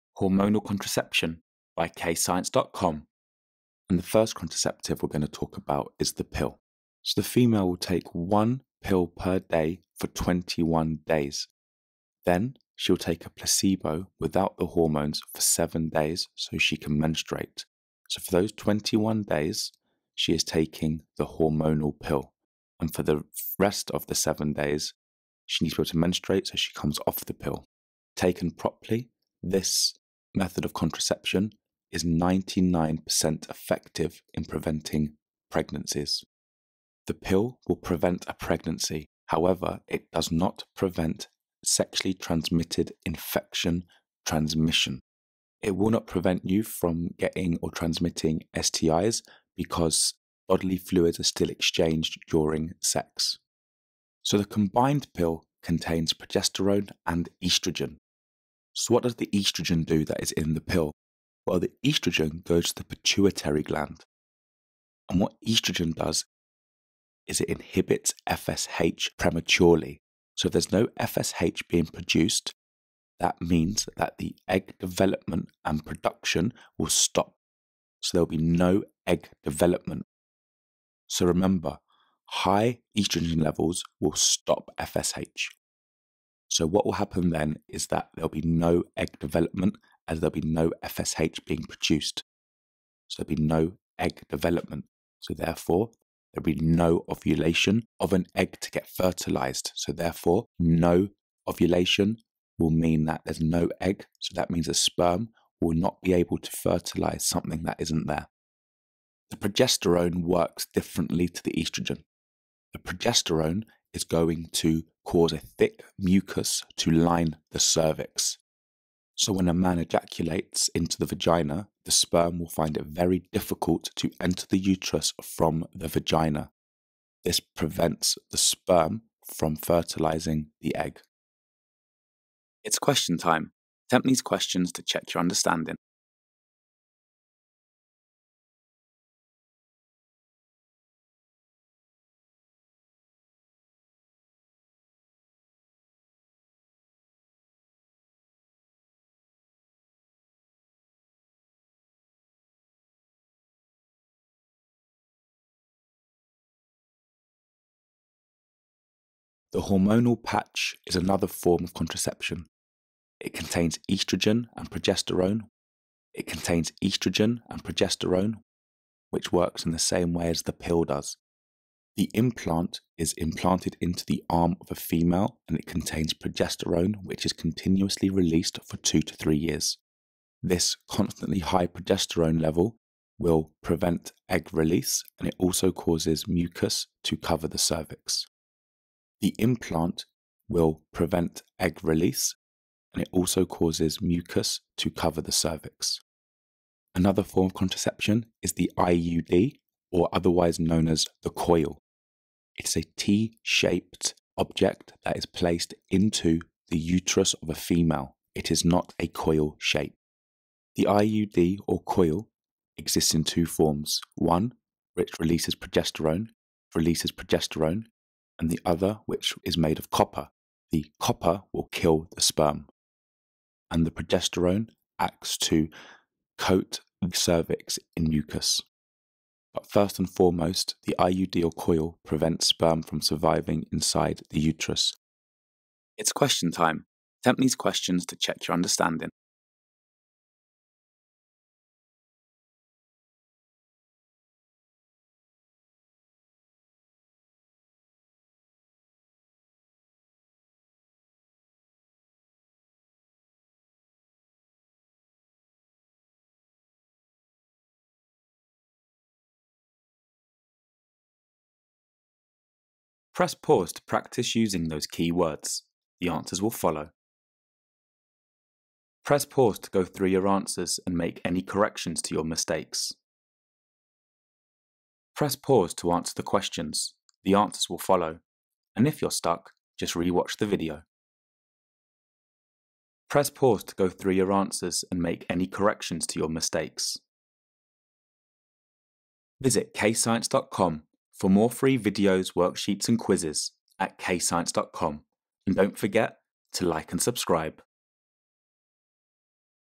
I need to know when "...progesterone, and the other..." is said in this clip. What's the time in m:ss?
3:37.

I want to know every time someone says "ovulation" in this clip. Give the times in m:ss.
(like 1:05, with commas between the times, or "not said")
1:37, 1:41.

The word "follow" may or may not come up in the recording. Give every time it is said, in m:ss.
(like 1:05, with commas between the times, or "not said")
4:26, 4:37.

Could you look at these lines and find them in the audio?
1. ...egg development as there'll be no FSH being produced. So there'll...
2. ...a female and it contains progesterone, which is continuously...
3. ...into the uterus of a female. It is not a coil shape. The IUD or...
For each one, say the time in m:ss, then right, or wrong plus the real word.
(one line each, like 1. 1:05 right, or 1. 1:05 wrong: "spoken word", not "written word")
1. 1:28 right
2. 2:54 right
3. 3:25 right.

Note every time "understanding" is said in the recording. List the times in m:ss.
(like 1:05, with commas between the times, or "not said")
2:15, 3:58.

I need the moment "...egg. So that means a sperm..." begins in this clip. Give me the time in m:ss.
1:43.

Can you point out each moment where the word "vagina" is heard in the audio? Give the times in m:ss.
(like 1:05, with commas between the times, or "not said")
2:01, 2:05.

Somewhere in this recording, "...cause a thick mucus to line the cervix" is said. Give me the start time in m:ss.
1:55.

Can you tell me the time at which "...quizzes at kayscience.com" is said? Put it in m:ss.
4:52.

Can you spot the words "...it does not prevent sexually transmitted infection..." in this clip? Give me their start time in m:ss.
0:39.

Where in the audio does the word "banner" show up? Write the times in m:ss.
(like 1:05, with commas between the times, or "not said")
not said.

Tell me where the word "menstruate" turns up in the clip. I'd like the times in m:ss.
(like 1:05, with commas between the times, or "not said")
0:16, 0:25.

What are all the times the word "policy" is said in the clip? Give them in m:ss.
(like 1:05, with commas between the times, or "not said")
not said.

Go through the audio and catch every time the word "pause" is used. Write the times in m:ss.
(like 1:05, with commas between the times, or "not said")
4:23, 4:29, 4:35, 4:43.